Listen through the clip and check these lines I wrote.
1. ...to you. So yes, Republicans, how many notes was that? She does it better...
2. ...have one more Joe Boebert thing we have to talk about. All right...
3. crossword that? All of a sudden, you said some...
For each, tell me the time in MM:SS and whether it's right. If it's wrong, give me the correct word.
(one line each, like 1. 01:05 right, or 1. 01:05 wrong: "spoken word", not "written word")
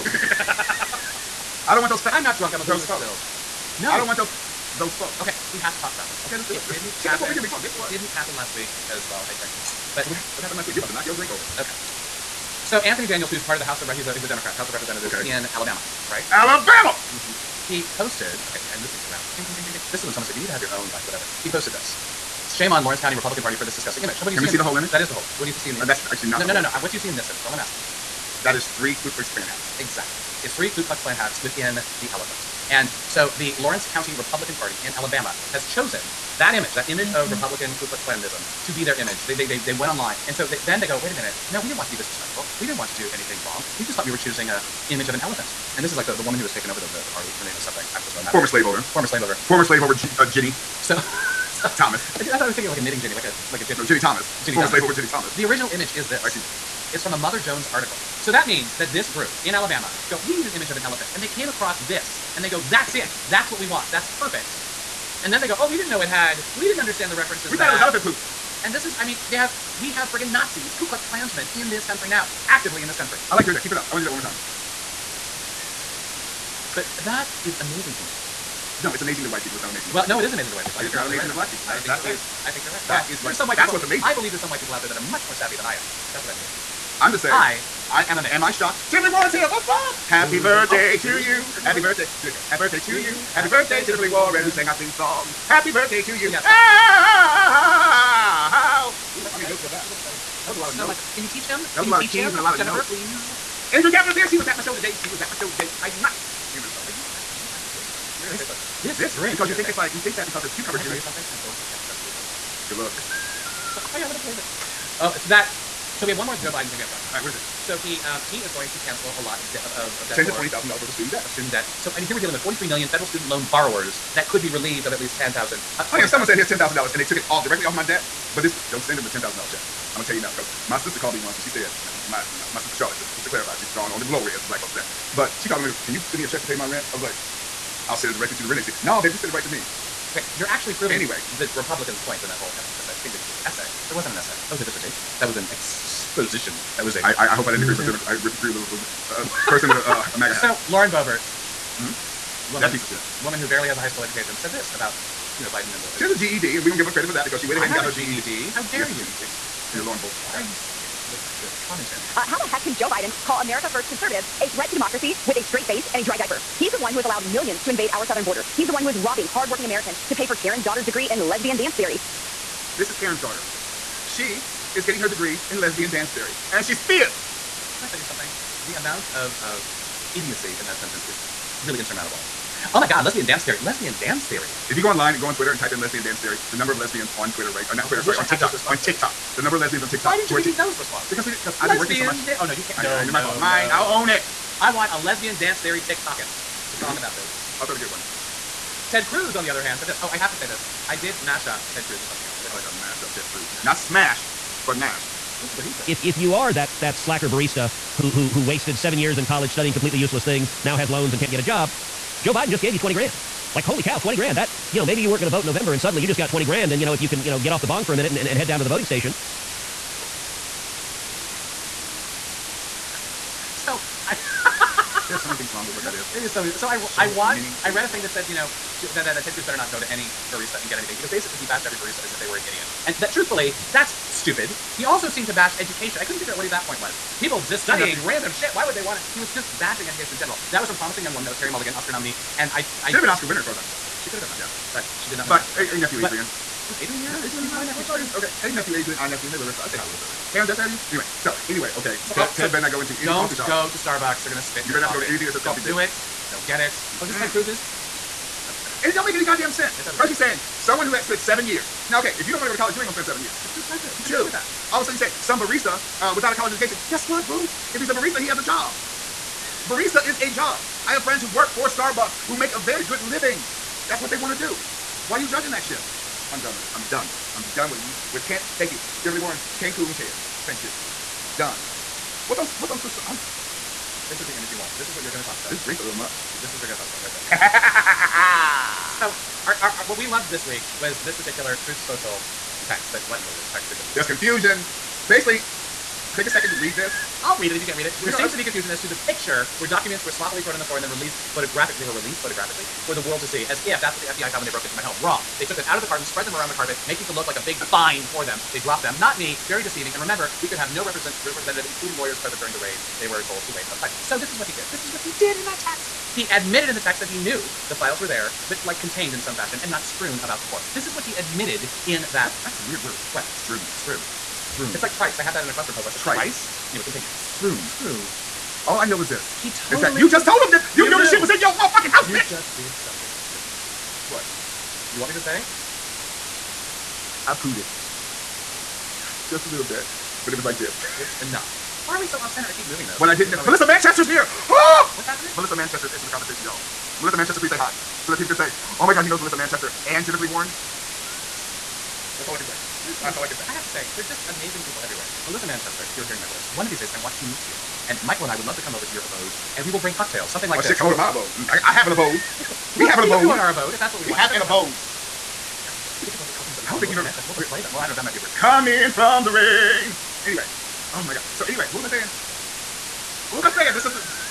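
1. 01:36 wrong: "Ooh", not "Republicans"
2. 01:56 wrong: "Biden", not "Boebert"
3. 04:24 wrong: "afford", not "crossword".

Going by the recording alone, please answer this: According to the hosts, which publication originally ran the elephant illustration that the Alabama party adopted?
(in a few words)
Mother Jones.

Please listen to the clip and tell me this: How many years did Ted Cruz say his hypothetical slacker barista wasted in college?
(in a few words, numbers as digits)
7.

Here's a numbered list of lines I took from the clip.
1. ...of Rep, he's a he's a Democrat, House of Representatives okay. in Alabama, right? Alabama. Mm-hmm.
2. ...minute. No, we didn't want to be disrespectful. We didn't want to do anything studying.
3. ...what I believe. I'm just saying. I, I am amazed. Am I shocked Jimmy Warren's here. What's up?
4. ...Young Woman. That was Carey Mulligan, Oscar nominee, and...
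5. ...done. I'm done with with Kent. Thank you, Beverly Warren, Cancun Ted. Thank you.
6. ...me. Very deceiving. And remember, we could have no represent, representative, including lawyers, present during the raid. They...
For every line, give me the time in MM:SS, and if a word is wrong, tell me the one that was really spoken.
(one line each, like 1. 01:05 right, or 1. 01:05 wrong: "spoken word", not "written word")
1. 00:13 right
2. 00:41 wrong: "wrong", not "studying"
3. 01:26 right
4. 04:01 right
5. 04:36 right
6. 05:09 right.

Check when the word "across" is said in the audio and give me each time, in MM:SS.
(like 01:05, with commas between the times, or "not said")
01:01.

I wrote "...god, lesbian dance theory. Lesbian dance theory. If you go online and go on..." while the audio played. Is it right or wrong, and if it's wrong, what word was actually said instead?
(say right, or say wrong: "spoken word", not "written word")
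right.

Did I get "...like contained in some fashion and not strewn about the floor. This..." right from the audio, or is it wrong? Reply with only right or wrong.
right.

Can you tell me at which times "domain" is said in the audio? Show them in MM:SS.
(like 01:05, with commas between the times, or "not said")
not said.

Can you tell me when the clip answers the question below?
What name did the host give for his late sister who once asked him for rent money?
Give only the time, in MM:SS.
02:12.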